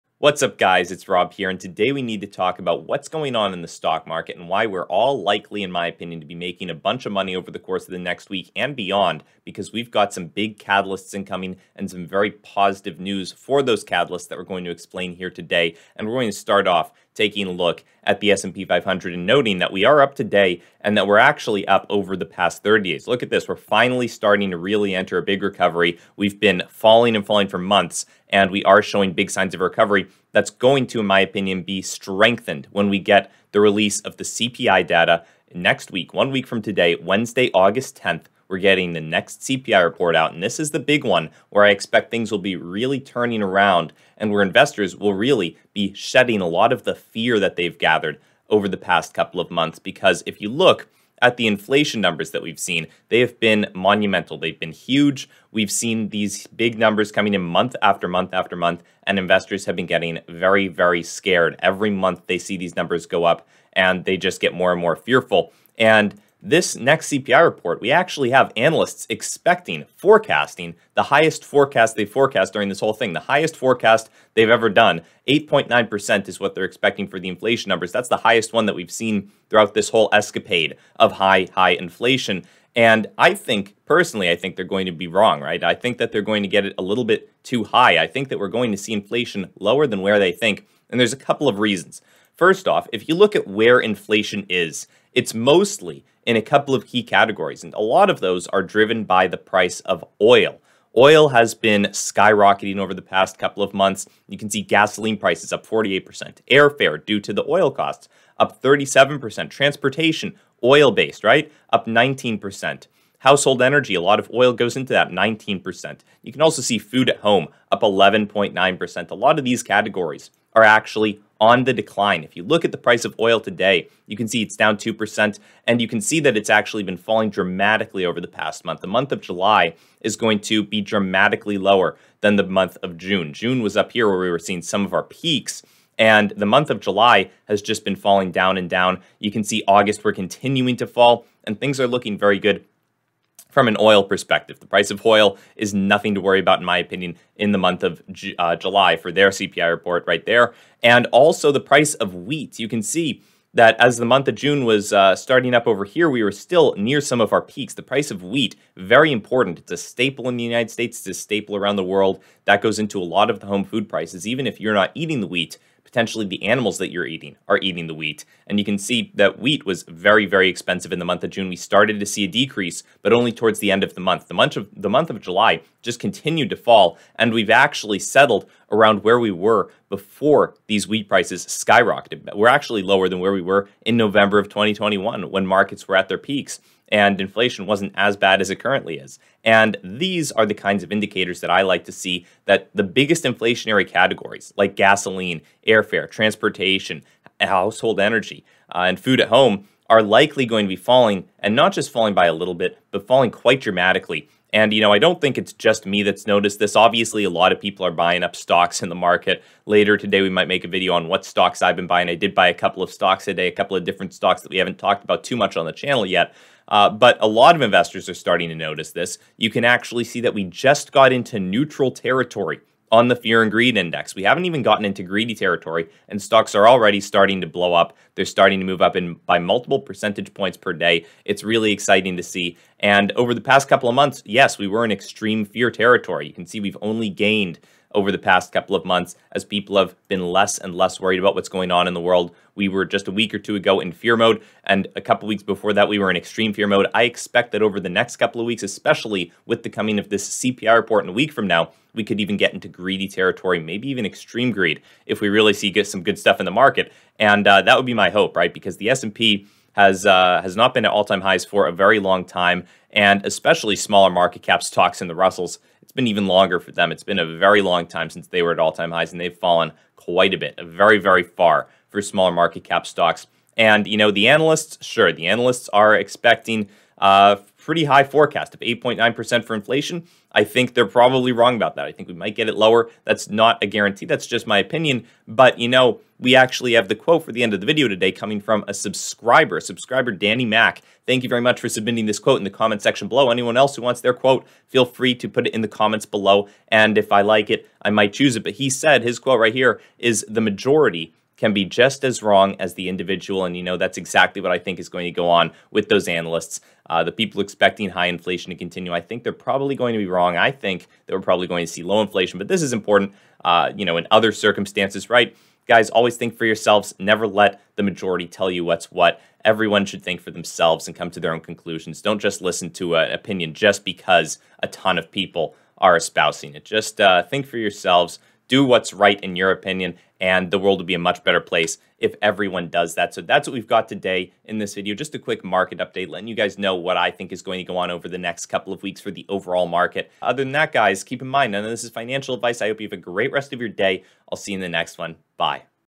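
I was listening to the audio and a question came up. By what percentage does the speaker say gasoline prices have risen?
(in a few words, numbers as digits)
48%.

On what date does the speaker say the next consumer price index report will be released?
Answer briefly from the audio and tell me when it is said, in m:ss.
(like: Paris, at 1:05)
August 10th, at 0:37.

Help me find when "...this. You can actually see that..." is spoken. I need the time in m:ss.
3:38.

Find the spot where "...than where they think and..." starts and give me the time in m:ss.
1:29.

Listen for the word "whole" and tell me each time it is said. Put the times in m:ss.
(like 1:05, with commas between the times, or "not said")
1:12, 1:19.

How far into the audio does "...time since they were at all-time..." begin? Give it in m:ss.
4:27.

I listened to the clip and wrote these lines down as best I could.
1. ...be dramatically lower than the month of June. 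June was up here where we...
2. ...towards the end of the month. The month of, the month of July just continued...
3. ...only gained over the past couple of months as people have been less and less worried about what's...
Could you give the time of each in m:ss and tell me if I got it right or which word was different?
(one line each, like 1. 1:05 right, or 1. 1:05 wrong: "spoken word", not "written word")
1. 2:10 right
2. 2:53 right
3. 3:56 right.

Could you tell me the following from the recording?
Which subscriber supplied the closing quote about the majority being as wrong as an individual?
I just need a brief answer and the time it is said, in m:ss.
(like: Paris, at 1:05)
Danny Mack, at 4:50.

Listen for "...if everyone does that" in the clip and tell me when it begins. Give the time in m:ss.
5:31.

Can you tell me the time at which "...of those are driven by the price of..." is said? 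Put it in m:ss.
1:38.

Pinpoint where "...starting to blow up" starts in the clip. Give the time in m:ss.
3:46.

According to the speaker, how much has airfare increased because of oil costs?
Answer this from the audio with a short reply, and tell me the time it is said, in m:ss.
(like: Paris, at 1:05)
37%, at 1:48.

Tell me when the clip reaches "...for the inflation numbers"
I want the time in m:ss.
1:17.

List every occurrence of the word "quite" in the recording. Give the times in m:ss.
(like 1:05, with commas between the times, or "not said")
3:23, 4:29.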